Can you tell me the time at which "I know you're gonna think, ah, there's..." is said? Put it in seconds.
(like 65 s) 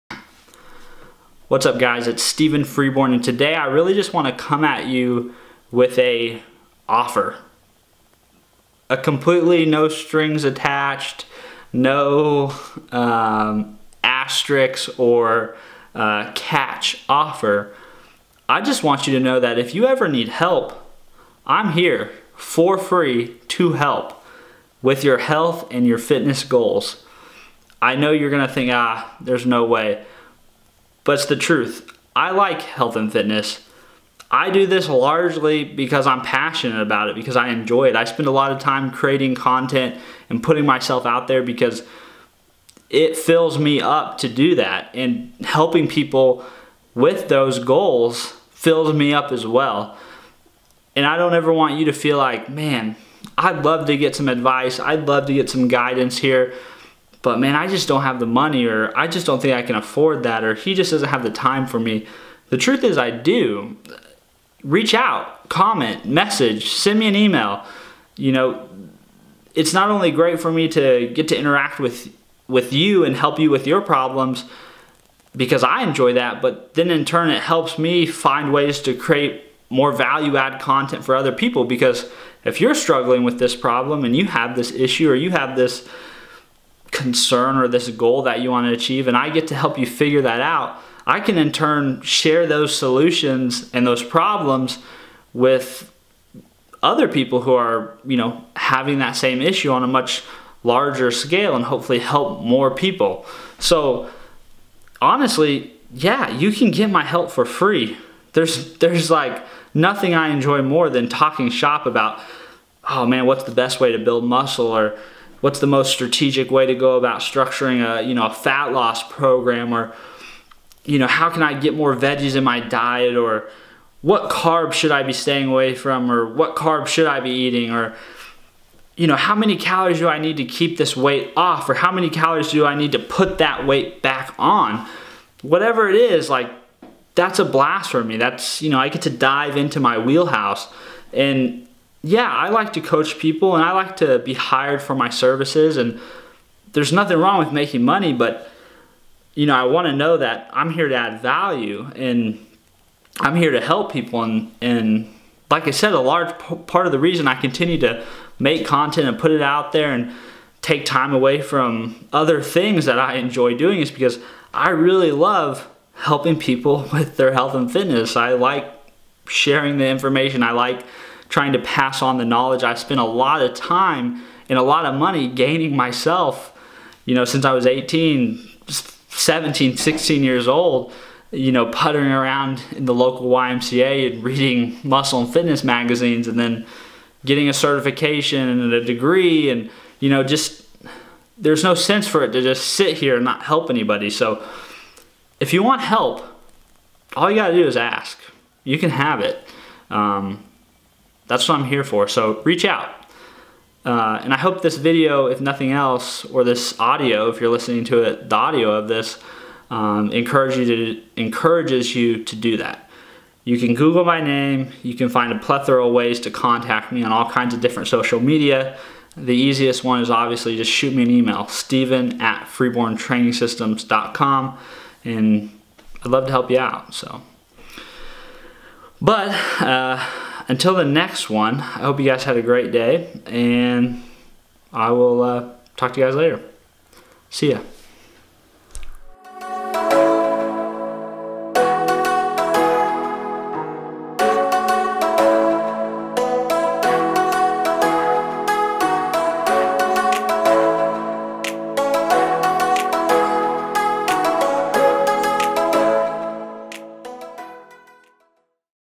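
27 s.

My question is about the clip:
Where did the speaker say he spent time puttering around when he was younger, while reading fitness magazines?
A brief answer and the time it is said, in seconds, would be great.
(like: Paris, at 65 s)
YMCA, at 183 s.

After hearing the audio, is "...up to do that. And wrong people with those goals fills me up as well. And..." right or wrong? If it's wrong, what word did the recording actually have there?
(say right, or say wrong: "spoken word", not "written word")
wrong: "helping", not "wrong".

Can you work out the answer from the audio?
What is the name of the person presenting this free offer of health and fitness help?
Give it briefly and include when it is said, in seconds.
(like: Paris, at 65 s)
Stevan Freeborn, at 2 s.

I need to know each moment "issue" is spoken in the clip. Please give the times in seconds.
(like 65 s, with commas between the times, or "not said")
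84 s, 99 s.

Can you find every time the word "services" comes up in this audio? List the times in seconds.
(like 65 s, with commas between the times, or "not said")
145 s.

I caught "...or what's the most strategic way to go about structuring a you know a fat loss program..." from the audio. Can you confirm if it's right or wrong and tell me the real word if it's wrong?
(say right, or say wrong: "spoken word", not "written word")
right.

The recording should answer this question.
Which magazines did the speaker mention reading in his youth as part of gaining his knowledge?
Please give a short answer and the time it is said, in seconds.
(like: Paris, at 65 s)
Muscle and Fitness, at 184 s.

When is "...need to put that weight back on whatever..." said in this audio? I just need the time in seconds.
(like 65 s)
132 s.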